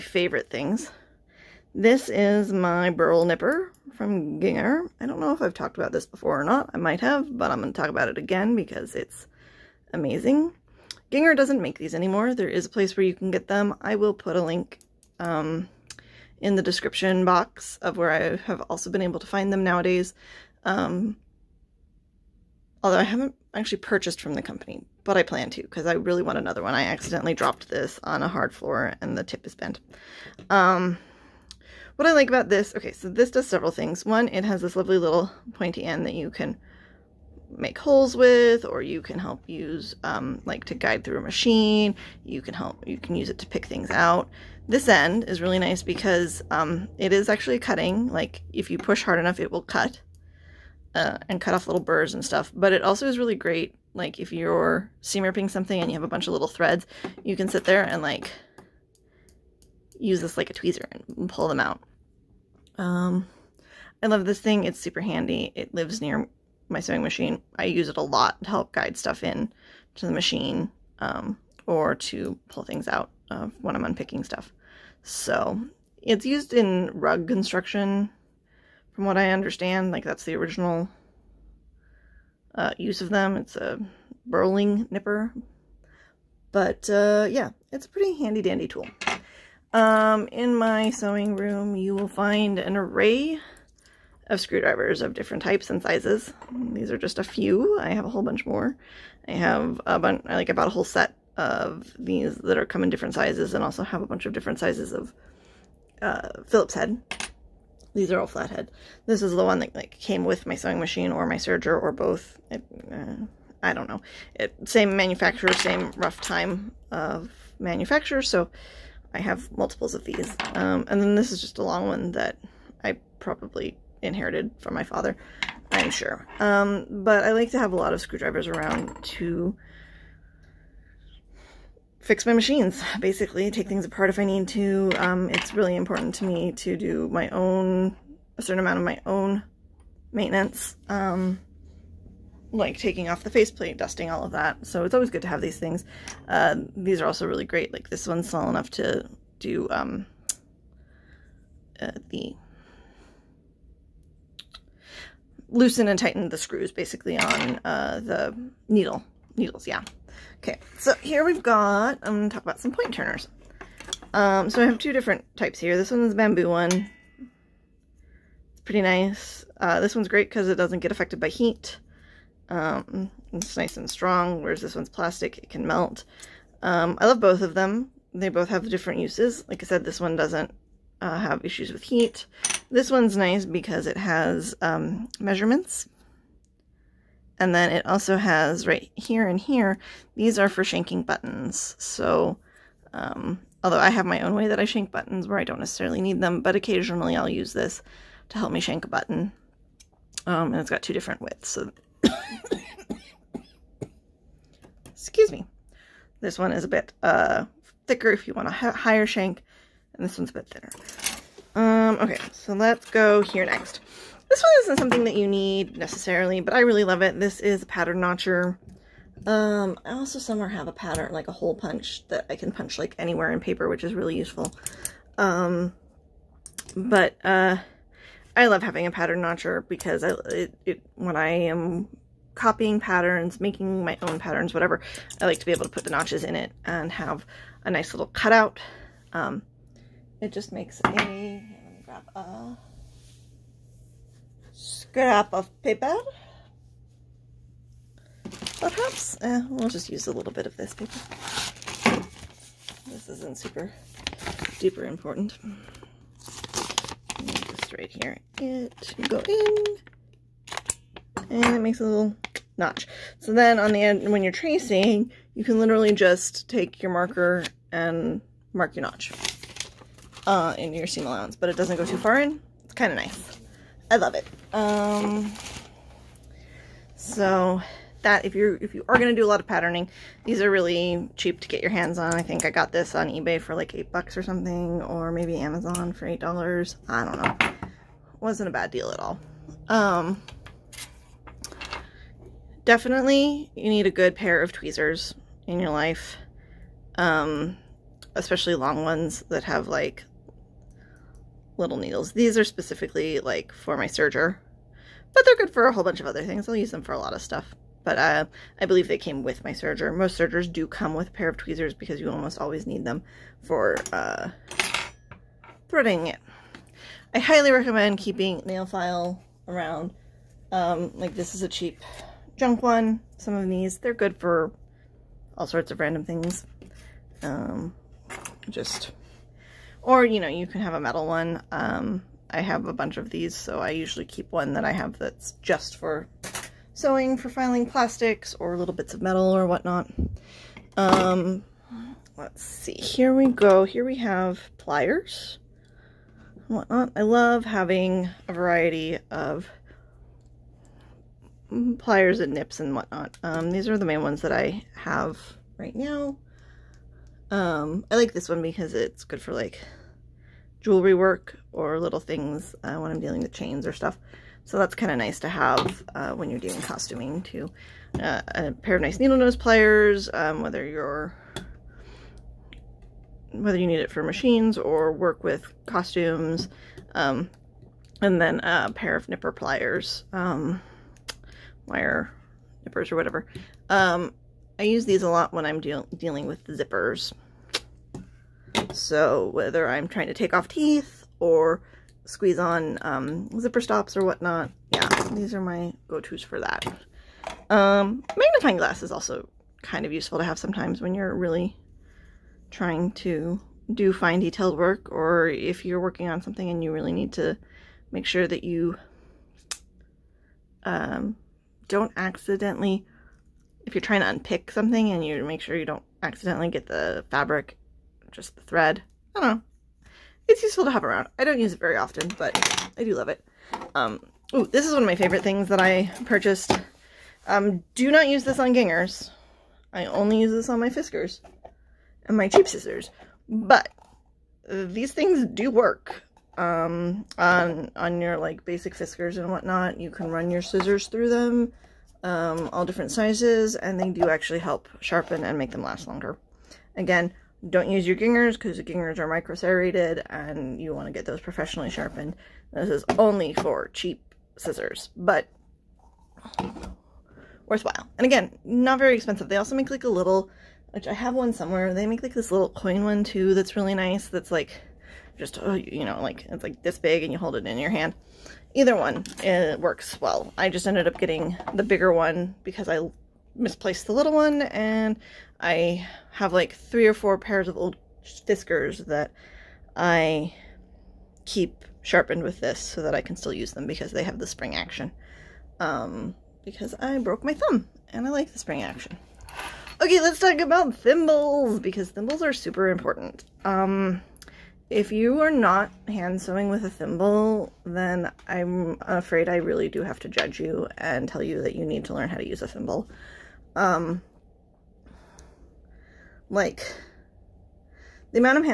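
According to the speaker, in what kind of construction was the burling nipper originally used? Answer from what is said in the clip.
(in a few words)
Rug construction.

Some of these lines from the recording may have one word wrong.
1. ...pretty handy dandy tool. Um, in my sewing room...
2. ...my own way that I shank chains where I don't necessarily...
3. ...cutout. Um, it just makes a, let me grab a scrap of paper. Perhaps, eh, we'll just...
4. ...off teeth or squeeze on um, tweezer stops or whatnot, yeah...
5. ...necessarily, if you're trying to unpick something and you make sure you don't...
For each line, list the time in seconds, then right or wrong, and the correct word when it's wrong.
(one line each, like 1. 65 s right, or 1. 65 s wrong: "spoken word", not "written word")
1. 87 s right
2. 194 s wrong: "buttons", not "chains"
3. 238 s right
4. 390 s wrong: "zipper", not "tweezer"
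5. 411 s wrong: "accidentally", not "necessarily".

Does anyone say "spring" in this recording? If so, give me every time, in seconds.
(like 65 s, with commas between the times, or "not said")
484 s, 488 s.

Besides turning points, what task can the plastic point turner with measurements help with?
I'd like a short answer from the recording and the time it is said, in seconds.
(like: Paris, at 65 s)
Shanking buttons, at 190 s.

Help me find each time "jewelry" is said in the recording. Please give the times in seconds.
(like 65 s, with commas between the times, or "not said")
360 s.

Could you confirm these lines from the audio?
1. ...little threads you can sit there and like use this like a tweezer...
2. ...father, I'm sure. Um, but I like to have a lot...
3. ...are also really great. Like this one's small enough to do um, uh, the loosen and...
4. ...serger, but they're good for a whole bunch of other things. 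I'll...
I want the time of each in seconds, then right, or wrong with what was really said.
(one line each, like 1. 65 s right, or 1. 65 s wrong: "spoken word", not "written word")
1. 56 s right
2. 124 s right
3. 147 s right
4. 303 s right.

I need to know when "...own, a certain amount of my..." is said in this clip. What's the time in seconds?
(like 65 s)
137 s.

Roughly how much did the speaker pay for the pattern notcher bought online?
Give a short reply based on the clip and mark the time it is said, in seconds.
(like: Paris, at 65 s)
$8, at 283 s.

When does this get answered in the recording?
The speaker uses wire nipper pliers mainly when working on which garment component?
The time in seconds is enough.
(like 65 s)
386 s.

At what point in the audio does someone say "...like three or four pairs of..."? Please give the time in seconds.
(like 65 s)
476 s.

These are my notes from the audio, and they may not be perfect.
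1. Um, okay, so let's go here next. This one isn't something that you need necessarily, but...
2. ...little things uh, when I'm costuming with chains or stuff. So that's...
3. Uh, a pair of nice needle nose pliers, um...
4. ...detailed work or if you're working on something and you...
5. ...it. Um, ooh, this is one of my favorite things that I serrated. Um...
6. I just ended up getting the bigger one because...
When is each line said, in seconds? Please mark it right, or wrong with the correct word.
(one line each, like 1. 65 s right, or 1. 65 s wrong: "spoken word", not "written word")
1. 211 s right
2. 361 s wrong: "dealing", not "costuming"
3. 367 s right
4. 404 s right
5. 423 s wrong: "purchased", not "serrated"
6. 470 s right.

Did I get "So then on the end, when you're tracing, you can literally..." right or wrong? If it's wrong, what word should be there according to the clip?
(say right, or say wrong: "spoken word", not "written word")
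right.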